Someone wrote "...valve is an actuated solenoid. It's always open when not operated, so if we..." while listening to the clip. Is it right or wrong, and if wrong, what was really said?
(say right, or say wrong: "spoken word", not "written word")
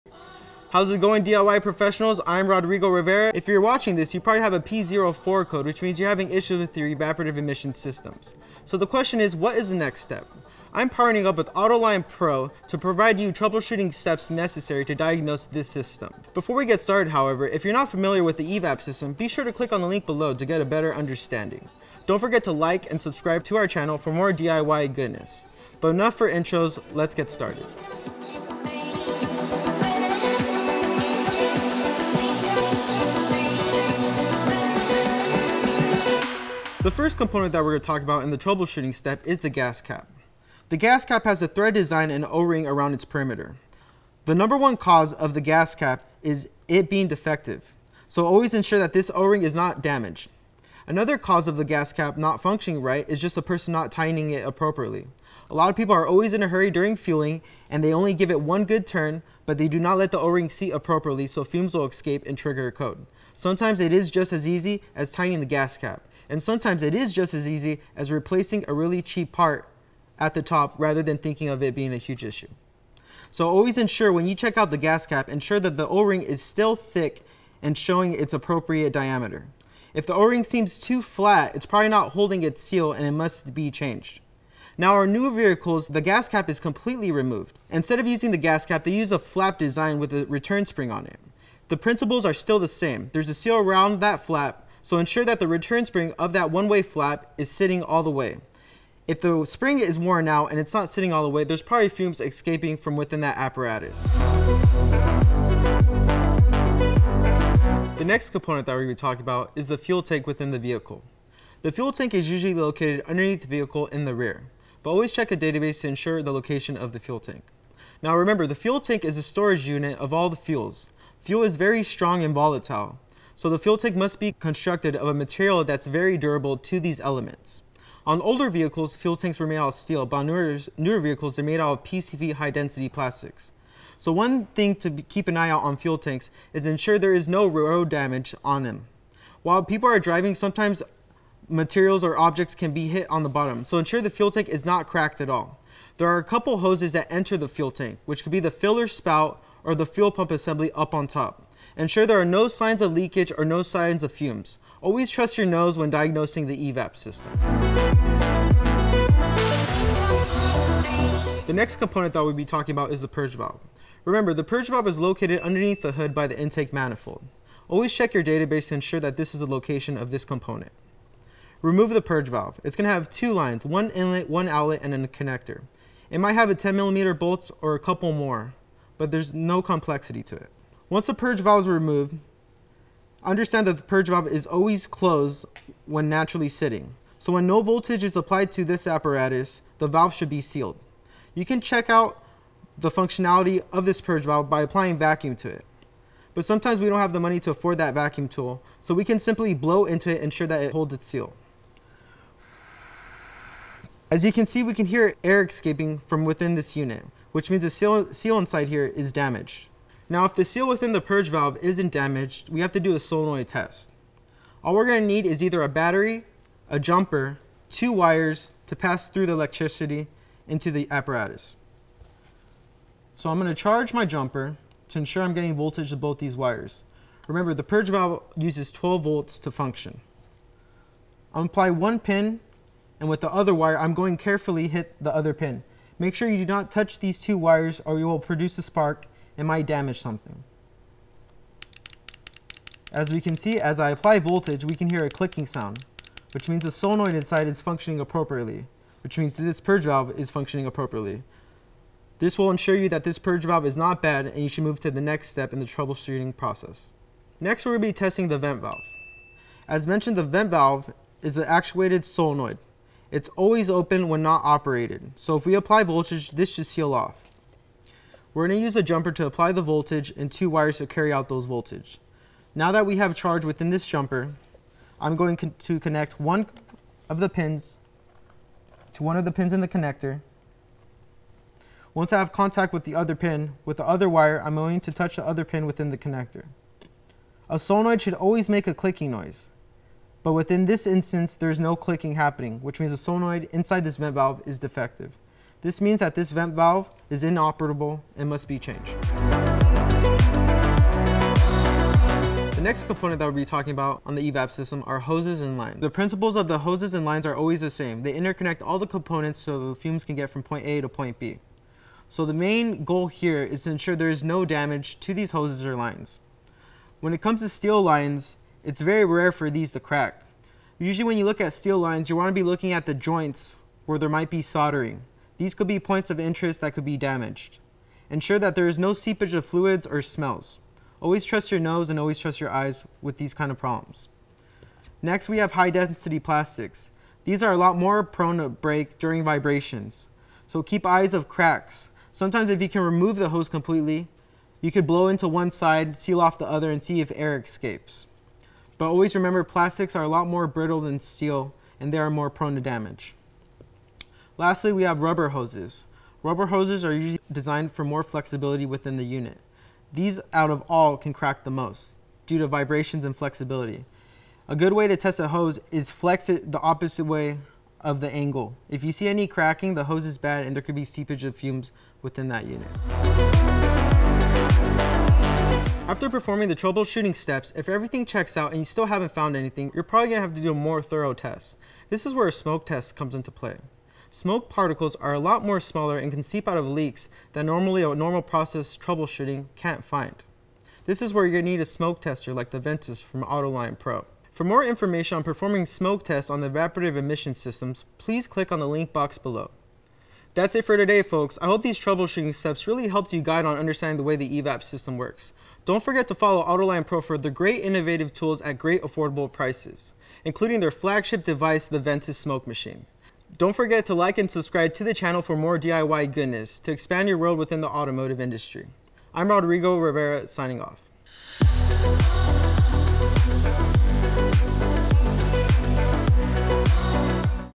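right.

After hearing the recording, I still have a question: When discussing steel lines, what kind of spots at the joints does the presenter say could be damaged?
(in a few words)
Soldering.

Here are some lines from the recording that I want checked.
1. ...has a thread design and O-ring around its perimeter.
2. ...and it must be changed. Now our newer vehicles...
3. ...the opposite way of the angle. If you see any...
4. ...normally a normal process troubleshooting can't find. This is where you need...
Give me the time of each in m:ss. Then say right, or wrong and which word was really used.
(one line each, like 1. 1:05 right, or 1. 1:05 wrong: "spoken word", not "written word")
1. 0:41 right
2. 1:22 right
3. 6:06 right
4. 6:27 right.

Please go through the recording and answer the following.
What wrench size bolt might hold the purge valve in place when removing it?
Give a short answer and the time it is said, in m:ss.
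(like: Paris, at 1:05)
10 millimeter, at 2:56.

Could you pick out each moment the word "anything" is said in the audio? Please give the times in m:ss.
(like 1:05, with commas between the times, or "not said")
6:19.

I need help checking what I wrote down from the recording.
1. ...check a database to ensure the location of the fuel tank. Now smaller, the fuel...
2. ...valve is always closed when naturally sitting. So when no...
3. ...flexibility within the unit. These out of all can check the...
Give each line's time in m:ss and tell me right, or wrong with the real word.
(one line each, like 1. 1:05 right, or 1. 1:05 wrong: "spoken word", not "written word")
1. 1:55 wrong: "remember", not "smaller"
2. 3:04 right
3. 5:58 wrong: "crack", not "check".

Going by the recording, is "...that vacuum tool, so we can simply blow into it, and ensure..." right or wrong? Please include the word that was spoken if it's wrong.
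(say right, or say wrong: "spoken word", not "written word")
right.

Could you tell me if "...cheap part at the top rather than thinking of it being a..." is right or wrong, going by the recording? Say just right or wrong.
right.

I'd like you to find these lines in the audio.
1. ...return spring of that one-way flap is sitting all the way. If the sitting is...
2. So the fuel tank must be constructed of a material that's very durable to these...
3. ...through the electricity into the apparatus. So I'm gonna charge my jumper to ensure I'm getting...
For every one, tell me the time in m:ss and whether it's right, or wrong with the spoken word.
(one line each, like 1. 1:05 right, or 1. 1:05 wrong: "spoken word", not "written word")
1. 1:35 wrong: "spring", not "sitting"
2. 2:03 right
3. 3:39 right.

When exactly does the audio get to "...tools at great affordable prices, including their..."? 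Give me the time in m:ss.
6:48.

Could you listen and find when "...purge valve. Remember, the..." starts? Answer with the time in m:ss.
2:43.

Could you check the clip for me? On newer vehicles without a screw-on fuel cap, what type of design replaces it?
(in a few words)
A flap design.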